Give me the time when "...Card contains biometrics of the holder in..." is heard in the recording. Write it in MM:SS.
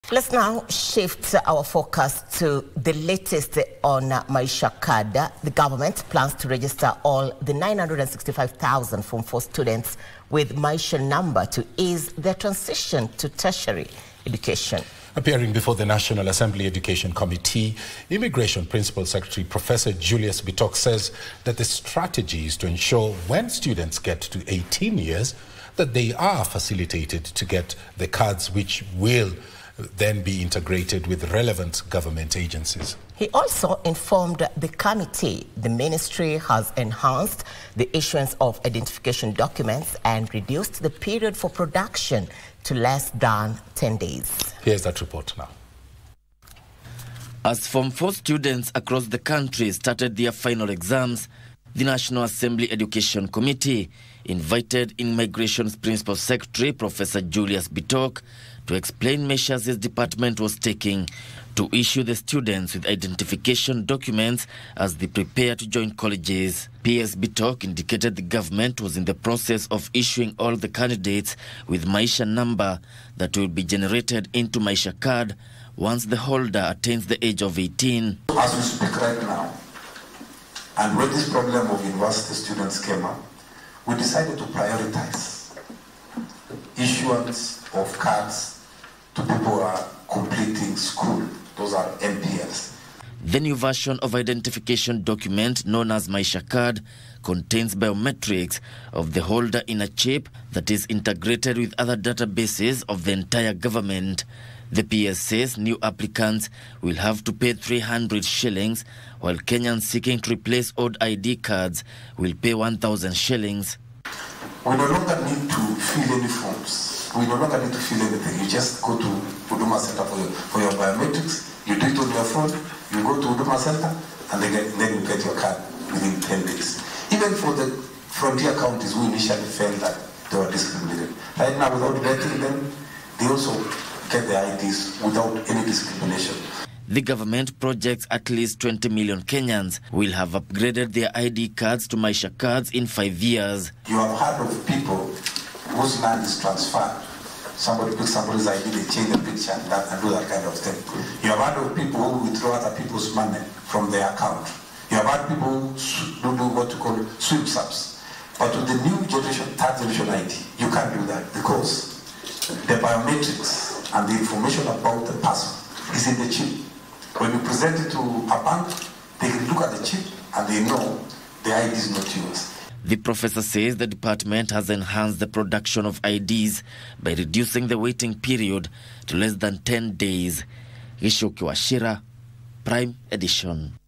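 01:36.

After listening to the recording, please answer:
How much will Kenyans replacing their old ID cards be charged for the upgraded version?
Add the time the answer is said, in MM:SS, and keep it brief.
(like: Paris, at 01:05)
1,000 shillings, at 01:52.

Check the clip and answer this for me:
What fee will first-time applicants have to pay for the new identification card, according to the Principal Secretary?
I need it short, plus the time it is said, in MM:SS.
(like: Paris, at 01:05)
300 shillings, at 01:47.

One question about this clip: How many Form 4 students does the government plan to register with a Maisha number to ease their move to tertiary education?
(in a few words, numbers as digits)
965,000.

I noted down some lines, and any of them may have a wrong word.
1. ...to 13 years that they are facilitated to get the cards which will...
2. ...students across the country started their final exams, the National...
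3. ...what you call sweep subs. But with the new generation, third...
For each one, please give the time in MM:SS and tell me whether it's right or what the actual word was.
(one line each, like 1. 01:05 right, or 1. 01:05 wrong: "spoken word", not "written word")
1. 00:24 wrong: "18", not "13"
2. 00:48 right
3. 02:36 right.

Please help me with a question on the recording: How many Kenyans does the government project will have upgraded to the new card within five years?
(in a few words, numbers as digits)
20 million.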